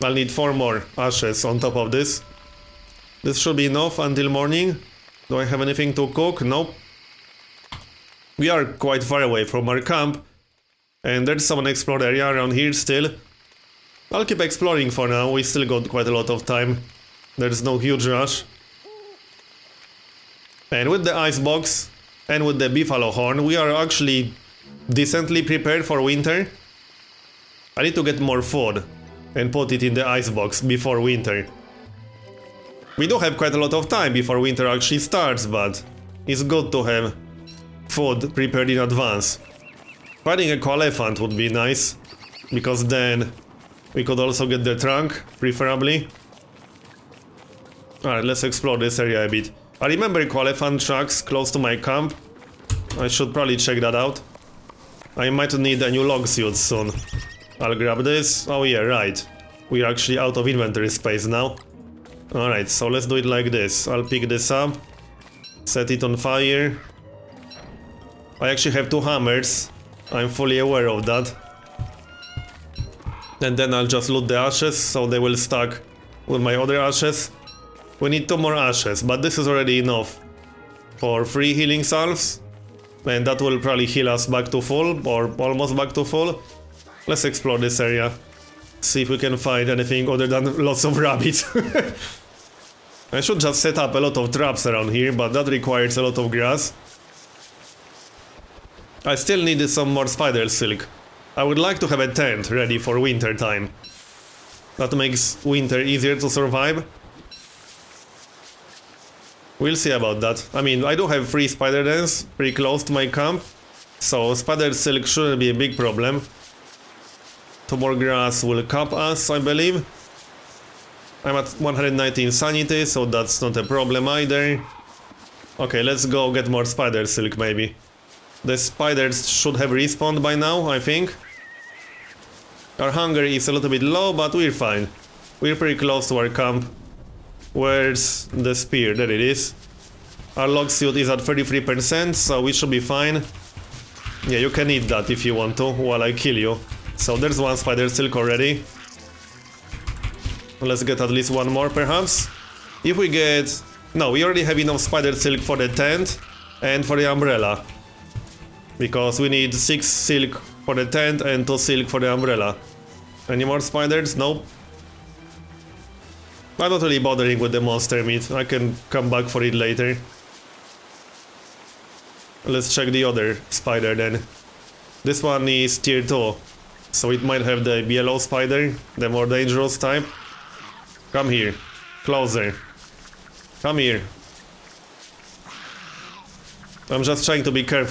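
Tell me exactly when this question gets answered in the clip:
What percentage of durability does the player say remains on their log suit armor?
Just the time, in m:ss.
2:21.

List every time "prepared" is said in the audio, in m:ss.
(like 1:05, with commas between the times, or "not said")
0:25, 0:38.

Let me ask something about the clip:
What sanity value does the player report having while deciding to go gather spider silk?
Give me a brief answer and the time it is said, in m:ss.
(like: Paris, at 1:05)
119, at 2:01.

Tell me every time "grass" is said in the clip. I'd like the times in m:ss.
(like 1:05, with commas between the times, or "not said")
1:36, 1:57.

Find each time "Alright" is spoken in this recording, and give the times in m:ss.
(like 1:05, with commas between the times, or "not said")
0:48, 1:02.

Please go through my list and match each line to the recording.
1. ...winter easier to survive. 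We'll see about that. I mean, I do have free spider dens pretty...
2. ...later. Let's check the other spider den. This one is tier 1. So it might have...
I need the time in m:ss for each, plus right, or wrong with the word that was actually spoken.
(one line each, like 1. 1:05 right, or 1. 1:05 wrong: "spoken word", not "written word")
1. 1:45 right
2. 2:49 wrong: "2", not "1".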